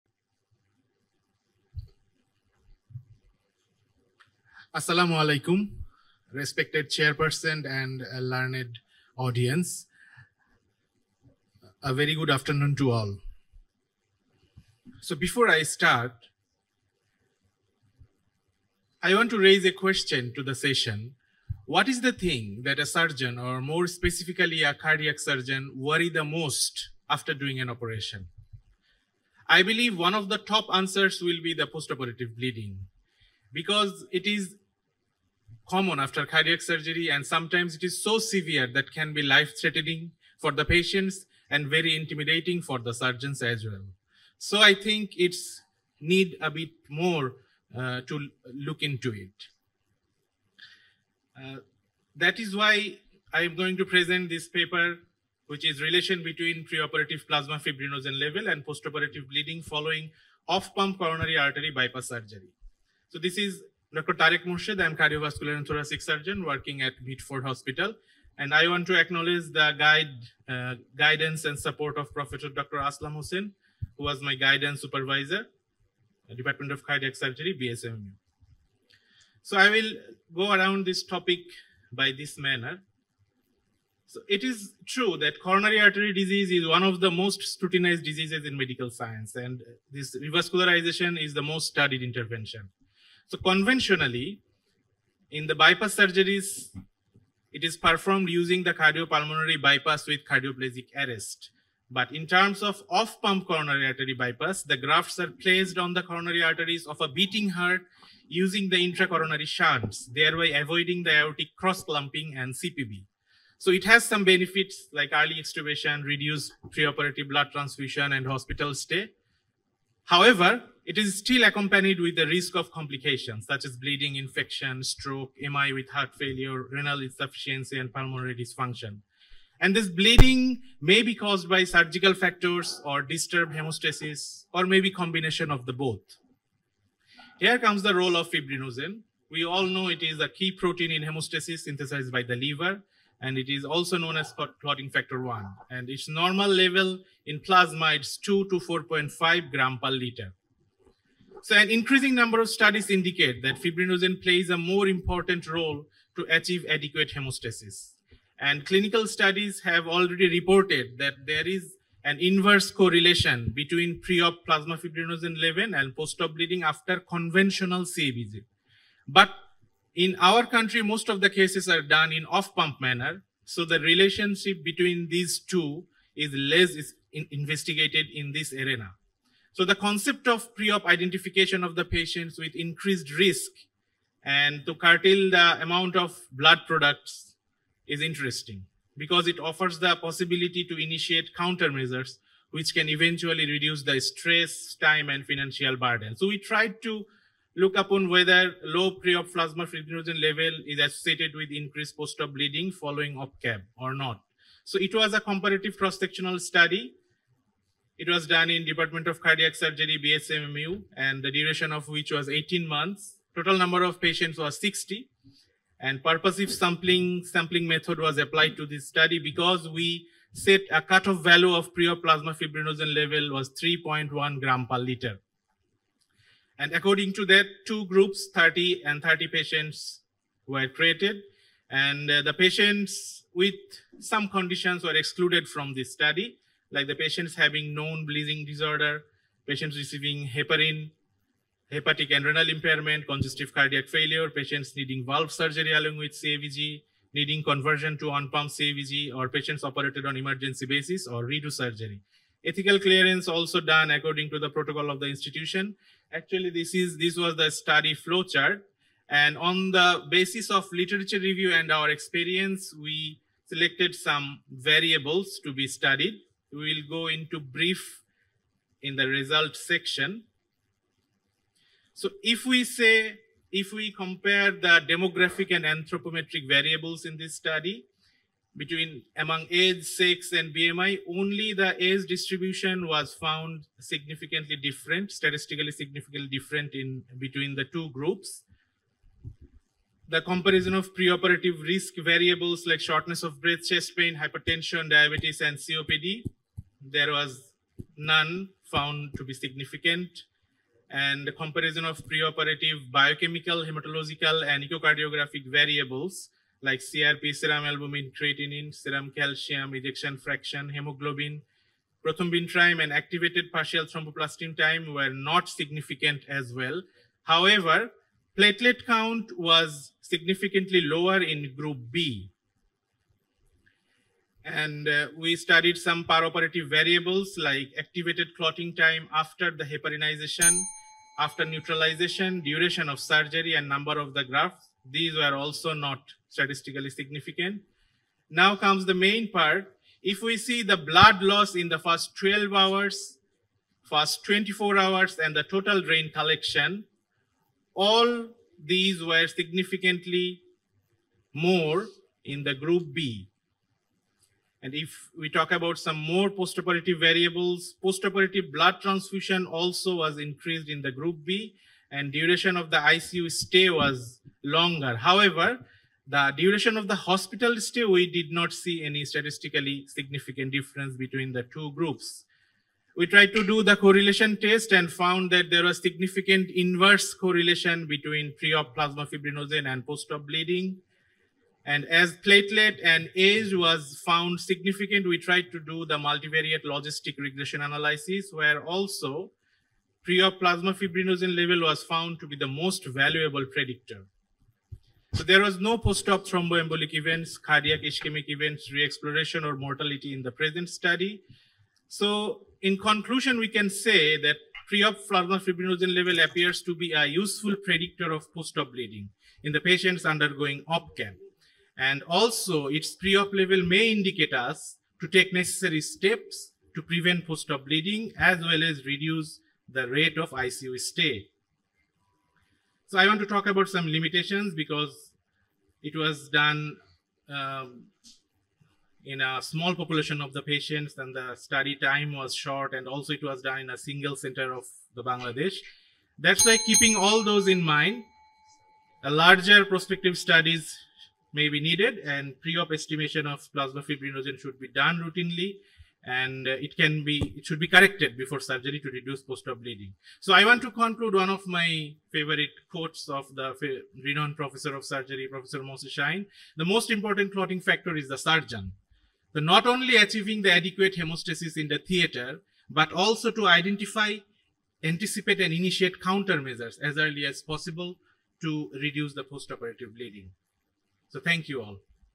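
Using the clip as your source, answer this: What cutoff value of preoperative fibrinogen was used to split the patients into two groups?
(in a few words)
3.1 grams per liter.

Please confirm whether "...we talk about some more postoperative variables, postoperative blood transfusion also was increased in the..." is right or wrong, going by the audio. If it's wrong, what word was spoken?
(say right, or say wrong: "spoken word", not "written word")
right.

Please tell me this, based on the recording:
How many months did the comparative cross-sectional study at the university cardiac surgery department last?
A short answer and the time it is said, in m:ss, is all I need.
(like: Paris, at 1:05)
18, at 3:32.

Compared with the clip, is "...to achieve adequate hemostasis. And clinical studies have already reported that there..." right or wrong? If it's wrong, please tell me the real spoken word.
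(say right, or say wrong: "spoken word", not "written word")
right.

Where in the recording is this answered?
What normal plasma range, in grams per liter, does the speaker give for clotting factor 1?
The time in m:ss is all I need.
2:28.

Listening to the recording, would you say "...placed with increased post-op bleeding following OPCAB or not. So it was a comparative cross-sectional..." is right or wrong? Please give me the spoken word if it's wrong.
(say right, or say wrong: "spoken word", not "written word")
wrong: "associated", not "placed".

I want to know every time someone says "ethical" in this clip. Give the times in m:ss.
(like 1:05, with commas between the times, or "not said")
4:12.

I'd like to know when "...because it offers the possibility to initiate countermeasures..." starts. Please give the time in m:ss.
3:08.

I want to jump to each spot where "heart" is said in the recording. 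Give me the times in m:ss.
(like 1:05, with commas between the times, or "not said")
1:47, 2:05.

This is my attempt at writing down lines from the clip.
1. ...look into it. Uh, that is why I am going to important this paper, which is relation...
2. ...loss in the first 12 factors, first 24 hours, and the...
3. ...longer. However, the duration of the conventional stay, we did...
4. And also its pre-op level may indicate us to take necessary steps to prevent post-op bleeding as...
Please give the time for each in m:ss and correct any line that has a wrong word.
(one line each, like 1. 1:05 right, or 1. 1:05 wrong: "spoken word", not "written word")
1. 0:48 wrong: "present", not "important"
2. 5:41 wrong: "hours", not "factors"
3. 6:04 wrong: "hospital", not "conventional"
4. 6:51 right.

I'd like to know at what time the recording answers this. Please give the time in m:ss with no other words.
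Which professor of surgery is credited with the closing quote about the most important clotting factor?
7:35.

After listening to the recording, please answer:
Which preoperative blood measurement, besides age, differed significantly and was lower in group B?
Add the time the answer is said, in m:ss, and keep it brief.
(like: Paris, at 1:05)
Platelet count, at 5:18.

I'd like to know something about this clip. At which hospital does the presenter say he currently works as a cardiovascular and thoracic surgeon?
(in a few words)
Beatford Hospital.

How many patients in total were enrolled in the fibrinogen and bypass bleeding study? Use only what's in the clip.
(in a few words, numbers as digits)
60.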